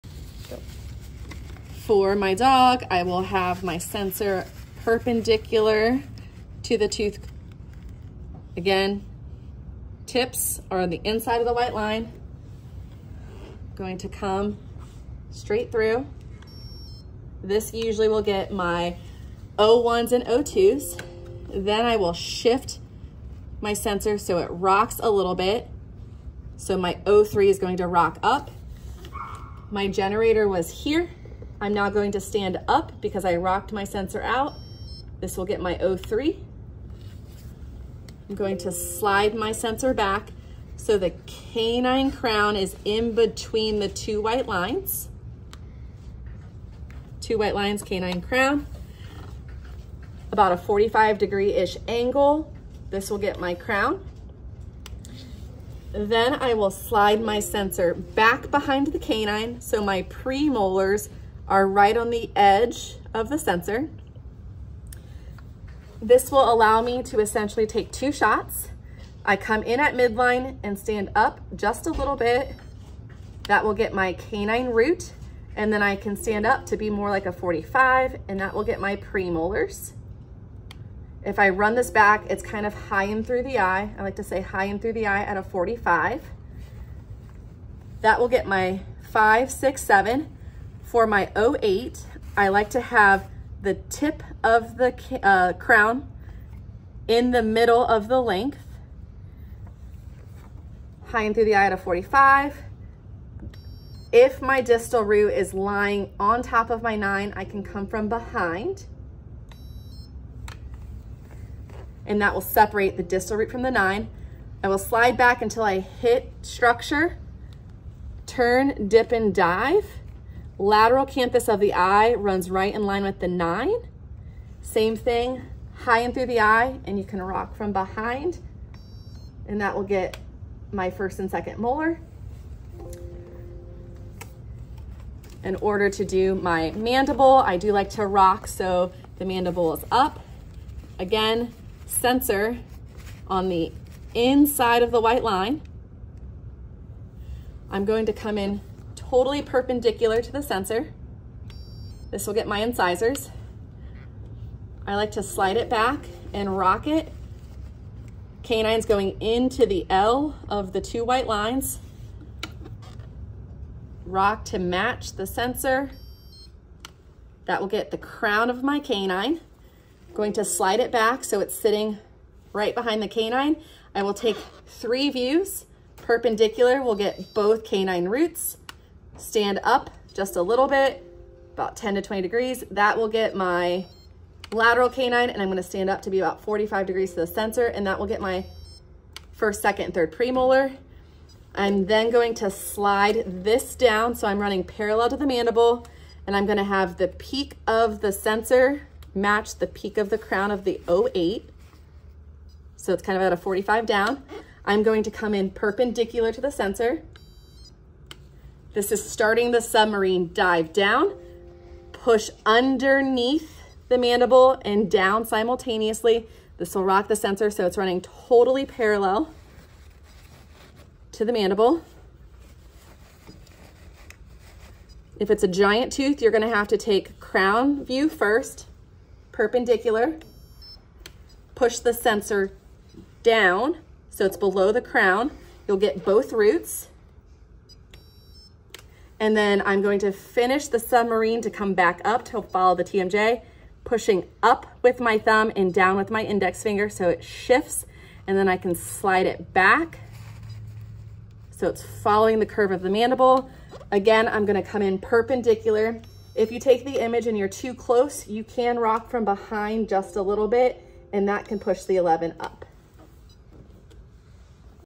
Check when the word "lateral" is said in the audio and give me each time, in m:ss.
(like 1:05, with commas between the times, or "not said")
2:00, 3:04.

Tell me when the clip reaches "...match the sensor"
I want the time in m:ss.
2:44.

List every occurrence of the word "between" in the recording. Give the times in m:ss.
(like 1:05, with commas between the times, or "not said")
0:43.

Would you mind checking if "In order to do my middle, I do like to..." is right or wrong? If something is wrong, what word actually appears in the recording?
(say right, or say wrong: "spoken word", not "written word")
wrong: "mandible", not "middle".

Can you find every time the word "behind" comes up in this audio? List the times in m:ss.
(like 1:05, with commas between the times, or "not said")
0:58, 1:48, 2:07, 2:52, 4:19.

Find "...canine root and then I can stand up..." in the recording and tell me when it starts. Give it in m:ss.
1:14.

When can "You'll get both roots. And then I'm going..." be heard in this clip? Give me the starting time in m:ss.
3:55.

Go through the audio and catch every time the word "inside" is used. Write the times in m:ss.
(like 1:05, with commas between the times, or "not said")
0:11, 2:24.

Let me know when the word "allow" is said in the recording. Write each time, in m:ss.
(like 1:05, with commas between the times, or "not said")
1:06.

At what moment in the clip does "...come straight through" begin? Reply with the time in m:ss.
0:14.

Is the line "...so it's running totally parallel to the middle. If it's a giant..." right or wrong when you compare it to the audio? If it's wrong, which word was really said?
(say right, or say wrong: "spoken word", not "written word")
wrong: "mandible", not "middle".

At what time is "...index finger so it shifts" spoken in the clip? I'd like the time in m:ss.
4:06.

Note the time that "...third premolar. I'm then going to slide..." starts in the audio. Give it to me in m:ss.
3:09.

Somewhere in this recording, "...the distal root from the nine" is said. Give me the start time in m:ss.
1:52.